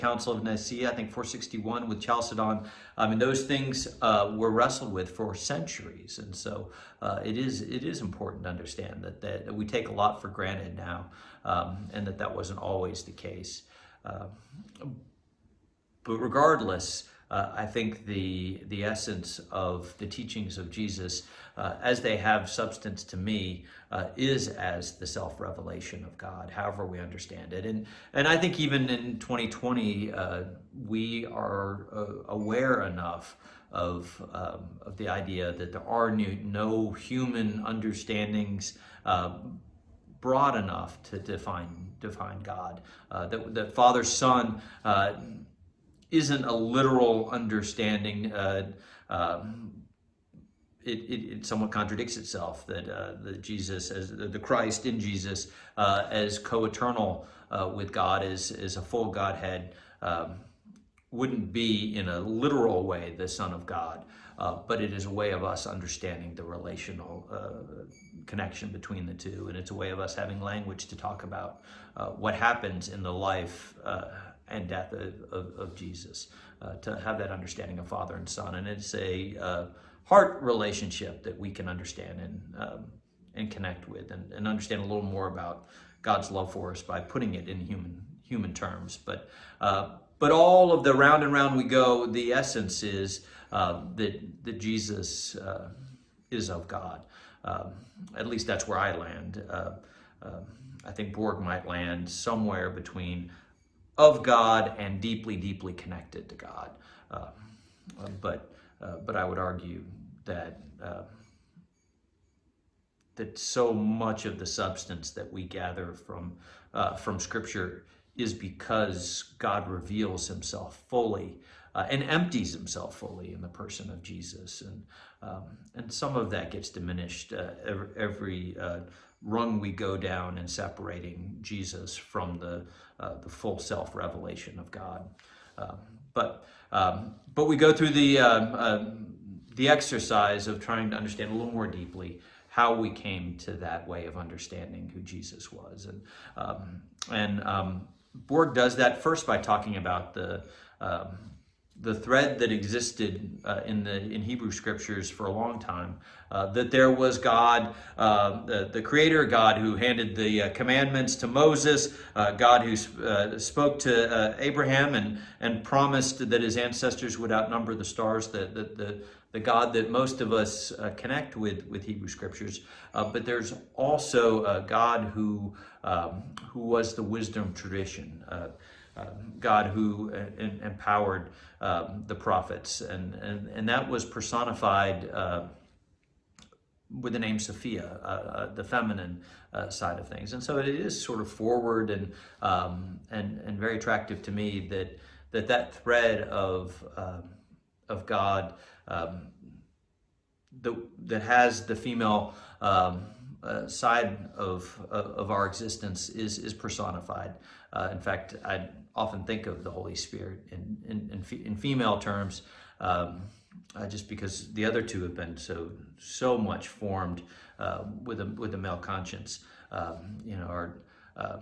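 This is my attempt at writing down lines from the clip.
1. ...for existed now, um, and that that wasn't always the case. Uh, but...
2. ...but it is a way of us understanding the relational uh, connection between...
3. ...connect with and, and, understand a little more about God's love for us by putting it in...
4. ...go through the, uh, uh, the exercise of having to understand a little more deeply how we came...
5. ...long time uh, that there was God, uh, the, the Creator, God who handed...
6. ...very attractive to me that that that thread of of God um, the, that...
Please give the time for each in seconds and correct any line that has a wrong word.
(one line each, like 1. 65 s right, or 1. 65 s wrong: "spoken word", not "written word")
1. 10 s wrong: "granted", not "existed"
2. 64 s right
3. 83 s right
4. 137 s wrong: "trying", not "having"
5. 155 s right
6. 193 s right.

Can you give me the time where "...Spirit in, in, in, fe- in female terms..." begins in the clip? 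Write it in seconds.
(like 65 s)
209 s.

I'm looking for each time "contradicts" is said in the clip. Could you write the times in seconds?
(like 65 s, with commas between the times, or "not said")
51 s.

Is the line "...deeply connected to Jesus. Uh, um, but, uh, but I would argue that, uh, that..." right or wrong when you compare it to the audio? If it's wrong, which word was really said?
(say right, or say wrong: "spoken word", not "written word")
wrong: "God", not "Jesus".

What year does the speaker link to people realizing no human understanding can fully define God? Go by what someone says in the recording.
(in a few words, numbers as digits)
2020.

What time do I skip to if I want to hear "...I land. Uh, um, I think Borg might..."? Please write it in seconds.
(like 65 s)
98 s.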